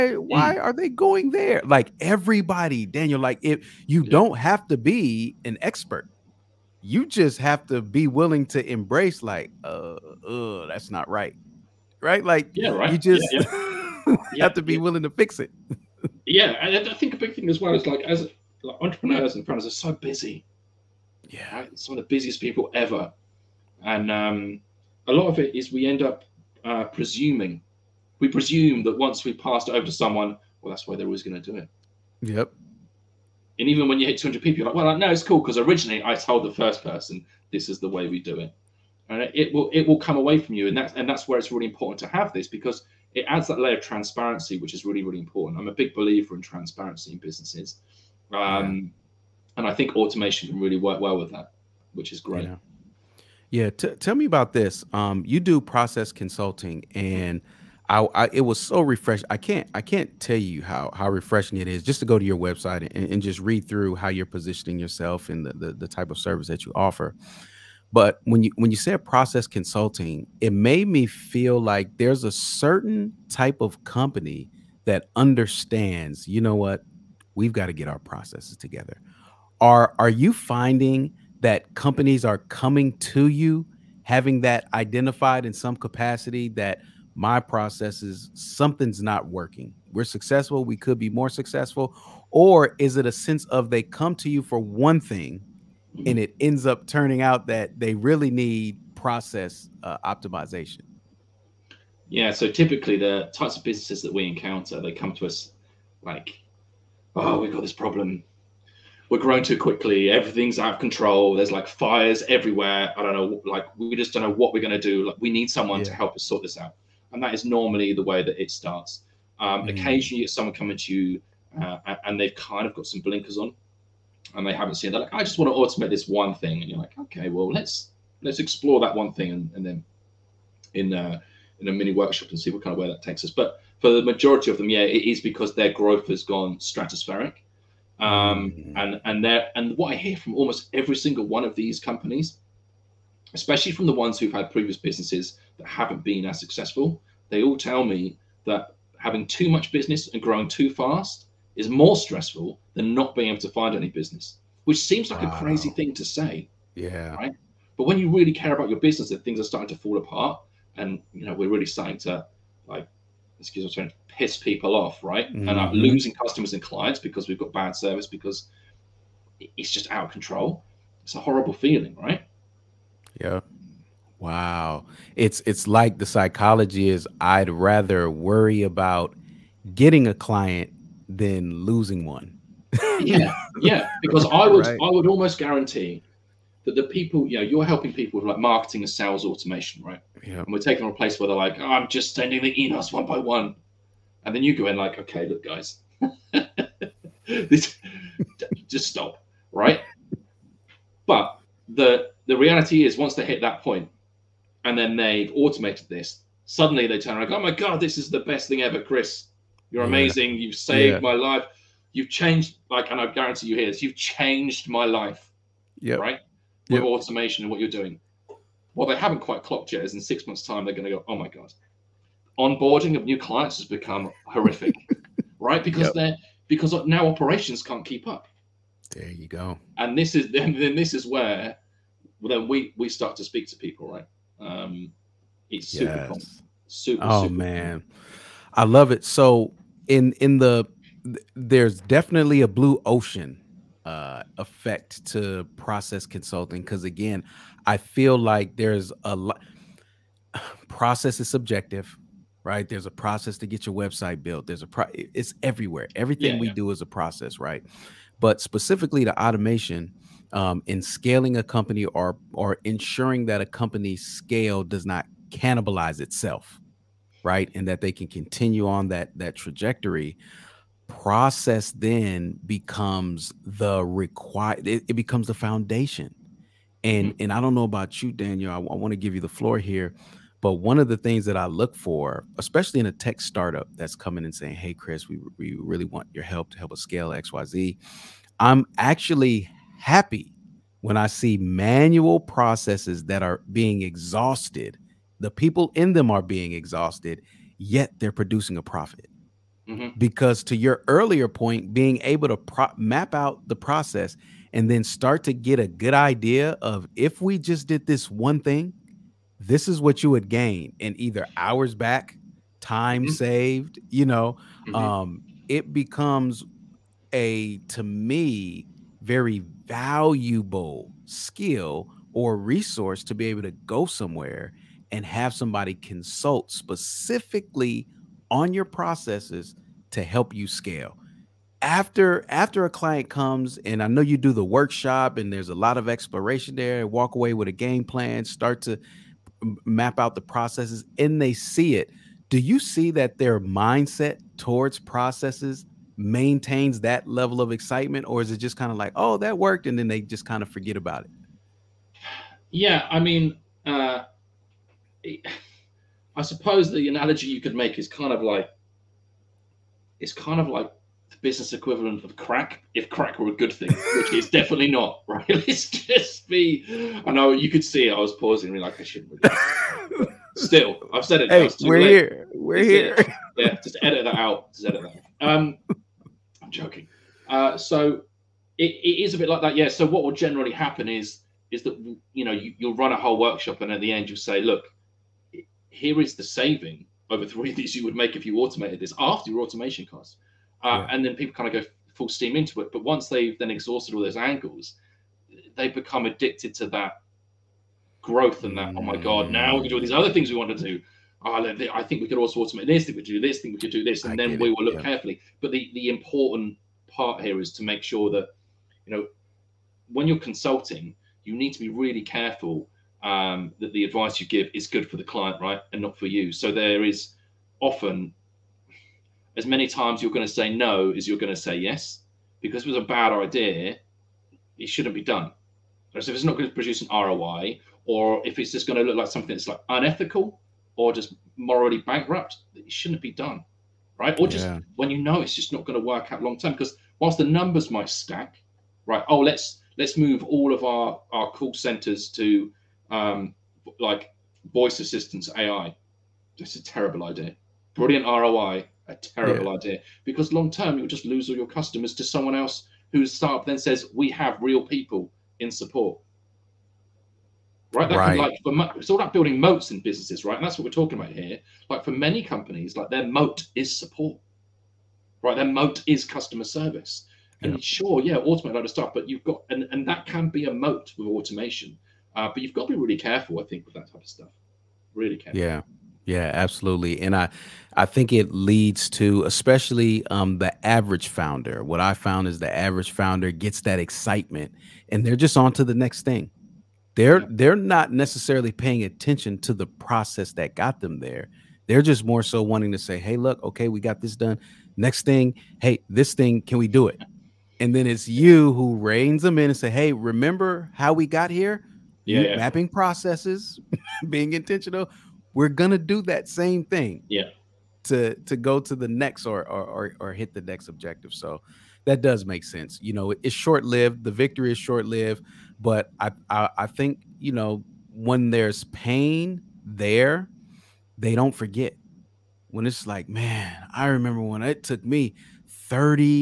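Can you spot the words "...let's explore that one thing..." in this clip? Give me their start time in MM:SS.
02:08.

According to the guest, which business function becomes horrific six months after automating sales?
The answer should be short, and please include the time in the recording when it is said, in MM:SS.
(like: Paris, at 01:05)
Onboarding of new clients, at 03:42.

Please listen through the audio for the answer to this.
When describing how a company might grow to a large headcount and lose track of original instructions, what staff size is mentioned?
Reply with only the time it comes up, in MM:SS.
00:34.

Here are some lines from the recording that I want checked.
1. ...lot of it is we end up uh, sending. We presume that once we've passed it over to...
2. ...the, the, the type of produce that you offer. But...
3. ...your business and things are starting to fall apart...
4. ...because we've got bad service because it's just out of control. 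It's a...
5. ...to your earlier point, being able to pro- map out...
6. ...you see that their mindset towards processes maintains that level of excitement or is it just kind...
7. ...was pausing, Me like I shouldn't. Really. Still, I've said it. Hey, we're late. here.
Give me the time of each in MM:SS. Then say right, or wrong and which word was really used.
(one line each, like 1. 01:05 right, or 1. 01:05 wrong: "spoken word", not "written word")
1. 00:25 wrong: "presuming", not "sending"
2. 01:05 wrong: "service", not "produce"
3. 02:38 right
4. 02:46 right
5. 05:00 right
6. 05:42 right
7. 06:07 right.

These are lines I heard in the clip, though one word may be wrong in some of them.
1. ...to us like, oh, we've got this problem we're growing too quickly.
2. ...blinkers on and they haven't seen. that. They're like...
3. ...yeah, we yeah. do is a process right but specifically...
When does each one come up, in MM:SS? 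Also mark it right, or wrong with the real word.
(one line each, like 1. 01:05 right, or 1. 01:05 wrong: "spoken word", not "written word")
1. 01:45 right
2. 02:03 right
3. 04:16 right.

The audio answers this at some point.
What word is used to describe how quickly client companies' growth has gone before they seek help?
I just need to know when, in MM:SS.
02:16.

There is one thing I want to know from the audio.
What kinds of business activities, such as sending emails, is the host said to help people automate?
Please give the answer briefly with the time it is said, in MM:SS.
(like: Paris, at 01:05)
Marketing and sales automation, at 03:08.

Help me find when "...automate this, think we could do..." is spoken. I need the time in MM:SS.
06:42.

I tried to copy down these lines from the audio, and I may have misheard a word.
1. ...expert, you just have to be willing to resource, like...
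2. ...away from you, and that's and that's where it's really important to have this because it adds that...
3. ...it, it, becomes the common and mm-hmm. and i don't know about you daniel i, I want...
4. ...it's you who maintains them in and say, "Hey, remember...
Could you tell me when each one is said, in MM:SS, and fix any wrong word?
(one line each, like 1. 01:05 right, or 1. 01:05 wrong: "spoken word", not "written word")
1. 00:05 wrong: "embrace", not "resource"
2. 00:40 right
3. 04:34 wrong: "foundation", not "common"
4. 08:17 wrong: "reins", not "maintains".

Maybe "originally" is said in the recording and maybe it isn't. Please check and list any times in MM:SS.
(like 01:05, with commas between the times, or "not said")
00:35.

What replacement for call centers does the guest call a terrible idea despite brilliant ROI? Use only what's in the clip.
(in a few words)
Voice assistance AI.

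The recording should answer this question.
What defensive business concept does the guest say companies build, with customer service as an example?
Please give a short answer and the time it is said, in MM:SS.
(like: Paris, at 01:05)
Moats, at 07:39.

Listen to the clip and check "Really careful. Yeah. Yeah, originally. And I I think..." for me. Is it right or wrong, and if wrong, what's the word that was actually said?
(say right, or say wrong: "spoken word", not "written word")
wrong: "absolutely", not "originally".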